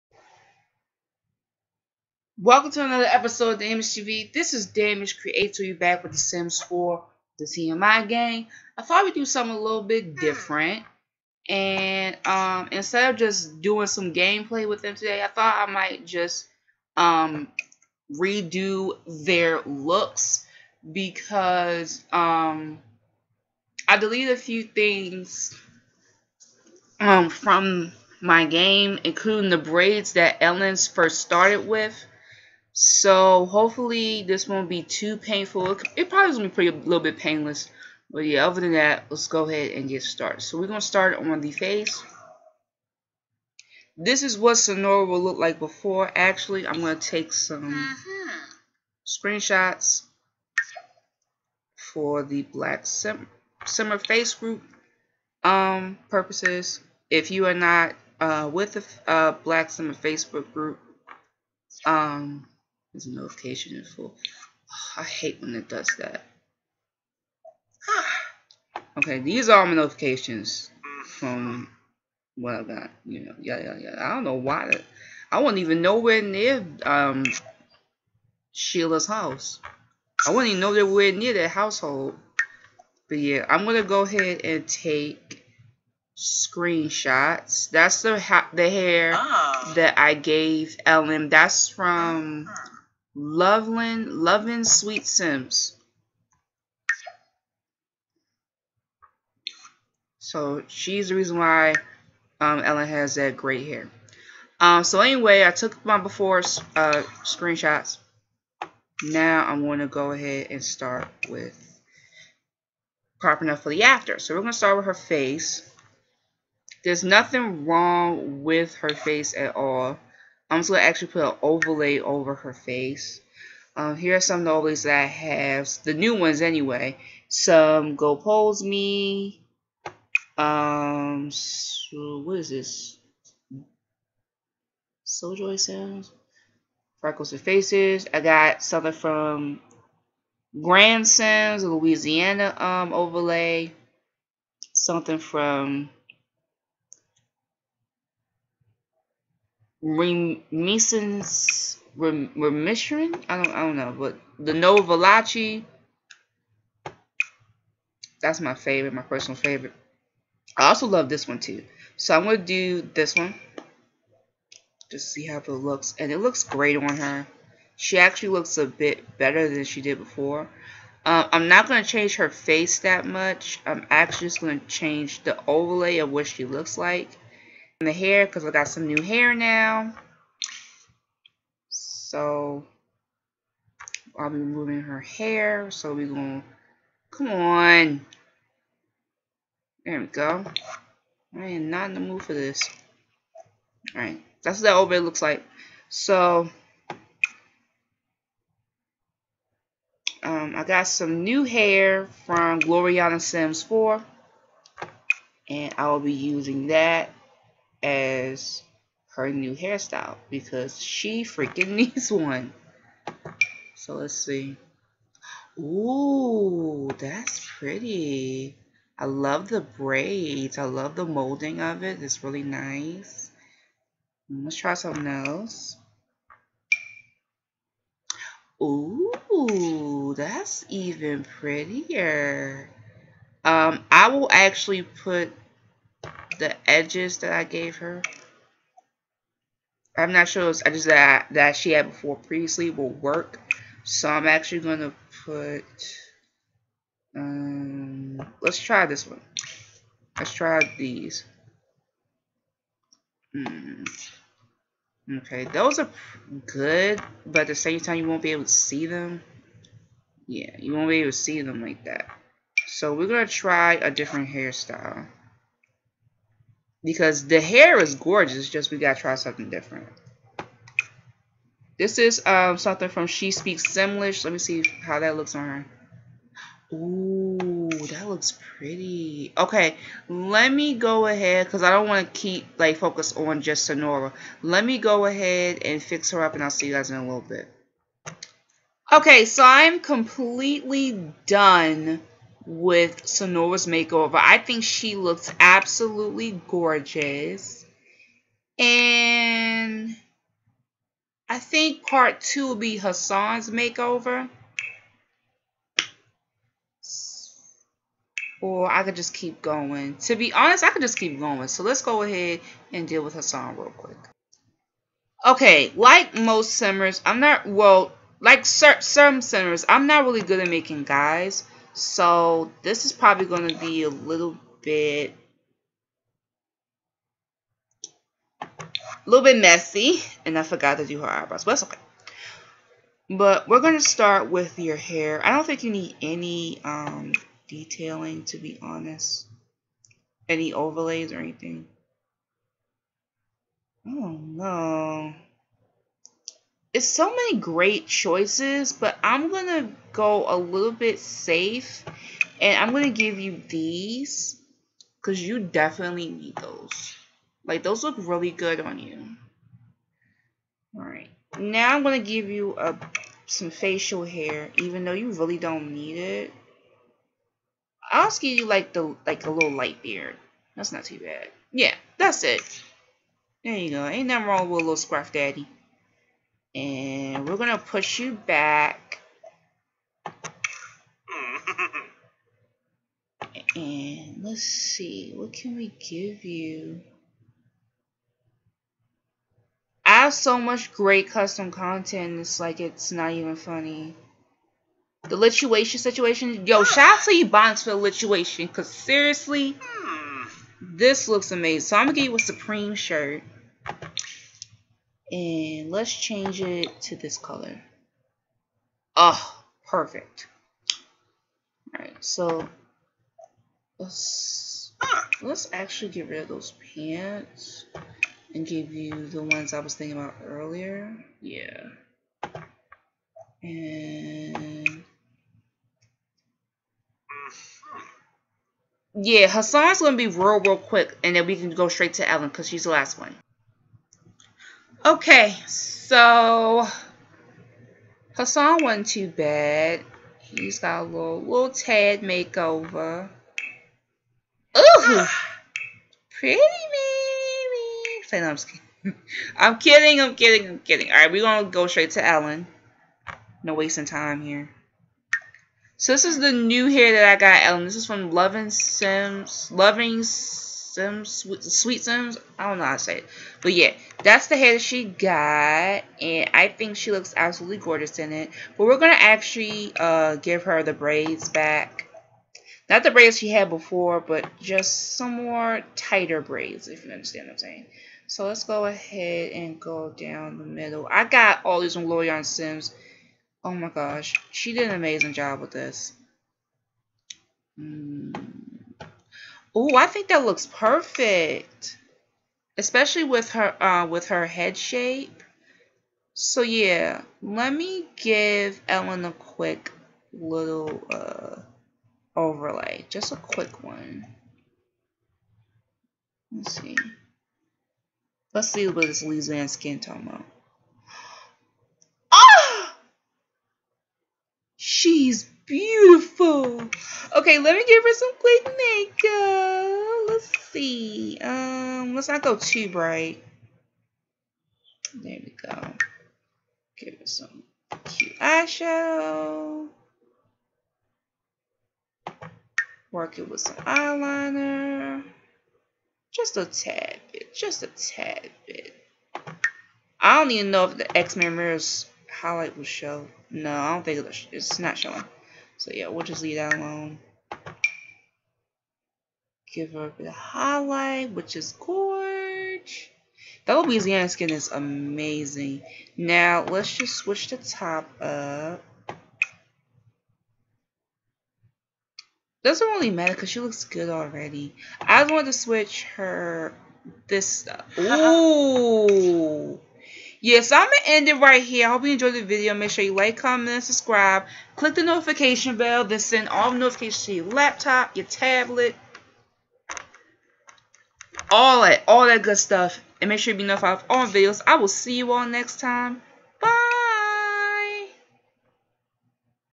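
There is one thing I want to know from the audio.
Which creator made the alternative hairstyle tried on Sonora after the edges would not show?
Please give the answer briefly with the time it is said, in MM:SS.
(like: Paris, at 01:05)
She Speaks Simlish, at 04:33.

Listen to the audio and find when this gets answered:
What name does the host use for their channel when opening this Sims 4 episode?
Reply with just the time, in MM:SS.
00:03.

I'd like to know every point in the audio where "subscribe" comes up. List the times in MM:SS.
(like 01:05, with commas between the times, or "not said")
09:33.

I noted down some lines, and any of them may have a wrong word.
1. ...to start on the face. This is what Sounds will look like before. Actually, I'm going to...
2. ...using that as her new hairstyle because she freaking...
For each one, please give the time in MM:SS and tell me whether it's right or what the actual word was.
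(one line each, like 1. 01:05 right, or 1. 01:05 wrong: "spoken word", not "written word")
1. 00:40 wrong: "Sonora", not "Sounds"
2. 03:26 right.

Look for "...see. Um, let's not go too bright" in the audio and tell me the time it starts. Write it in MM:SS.
08:40.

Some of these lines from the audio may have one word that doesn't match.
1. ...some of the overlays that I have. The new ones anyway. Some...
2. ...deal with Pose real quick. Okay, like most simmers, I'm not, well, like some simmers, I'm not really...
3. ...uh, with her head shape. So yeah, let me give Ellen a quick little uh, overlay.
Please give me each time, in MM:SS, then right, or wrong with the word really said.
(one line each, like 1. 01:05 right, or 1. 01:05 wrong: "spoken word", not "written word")
1. 02:04 right
2. 05:12 wrong: "Hassan", not "Pose"
3. 08:13 right.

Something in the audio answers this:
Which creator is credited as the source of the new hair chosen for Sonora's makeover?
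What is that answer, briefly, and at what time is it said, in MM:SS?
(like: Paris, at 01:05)
Gloriana Sims 4, at 03:22.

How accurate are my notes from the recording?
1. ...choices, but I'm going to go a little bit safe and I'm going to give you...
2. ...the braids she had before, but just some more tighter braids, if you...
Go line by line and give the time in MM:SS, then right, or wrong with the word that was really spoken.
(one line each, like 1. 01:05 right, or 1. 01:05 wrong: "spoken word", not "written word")
1. 05:47 right
2. 07:52 right.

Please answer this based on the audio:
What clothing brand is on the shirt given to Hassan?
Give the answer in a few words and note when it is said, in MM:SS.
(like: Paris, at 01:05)
Supreme, at 06:42.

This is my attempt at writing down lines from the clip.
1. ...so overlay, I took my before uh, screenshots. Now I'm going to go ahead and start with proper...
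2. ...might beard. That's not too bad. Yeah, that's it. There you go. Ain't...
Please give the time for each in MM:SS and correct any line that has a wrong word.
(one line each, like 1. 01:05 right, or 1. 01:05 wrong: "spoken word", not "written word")
1. 01:44 wrong: "anyway", not "overlay"
2. 06:09 wrong: "light", not "might".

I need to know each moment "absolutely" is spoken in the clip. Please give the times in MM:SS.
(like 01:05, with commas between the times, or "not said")
04:55, 07:47.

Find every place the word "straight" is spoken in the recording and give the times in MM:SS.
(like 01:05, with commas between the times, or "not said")
07:11, 07:31.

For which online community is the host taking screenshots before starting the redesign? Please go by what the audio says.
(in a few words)
Black Simmer Facebook group.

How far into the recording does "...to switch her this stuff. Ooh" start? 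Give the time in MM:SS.
09:25.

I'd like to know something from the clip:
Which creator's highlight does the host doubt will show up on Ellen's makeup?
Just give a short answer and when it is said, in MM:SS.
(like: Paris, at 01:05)
Xmiramira, at 09:00.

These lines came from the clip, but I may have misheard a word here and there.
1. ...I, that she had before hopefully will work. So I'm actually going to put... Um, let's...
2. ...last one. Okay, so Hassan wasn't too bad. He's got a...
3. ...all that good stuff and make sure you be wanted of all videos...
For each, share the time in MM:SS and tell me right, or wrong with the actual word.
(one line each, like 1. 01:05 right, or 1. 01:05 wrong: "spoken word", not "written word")
1. 04:01 wrong: "previously", not "hopefully"
2. 07:12 right
3. 09:41 wrong: "notified", not "wanted".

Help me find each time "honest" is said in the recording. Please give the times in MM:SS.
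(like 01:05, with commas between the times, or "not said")
05:10, 05:38.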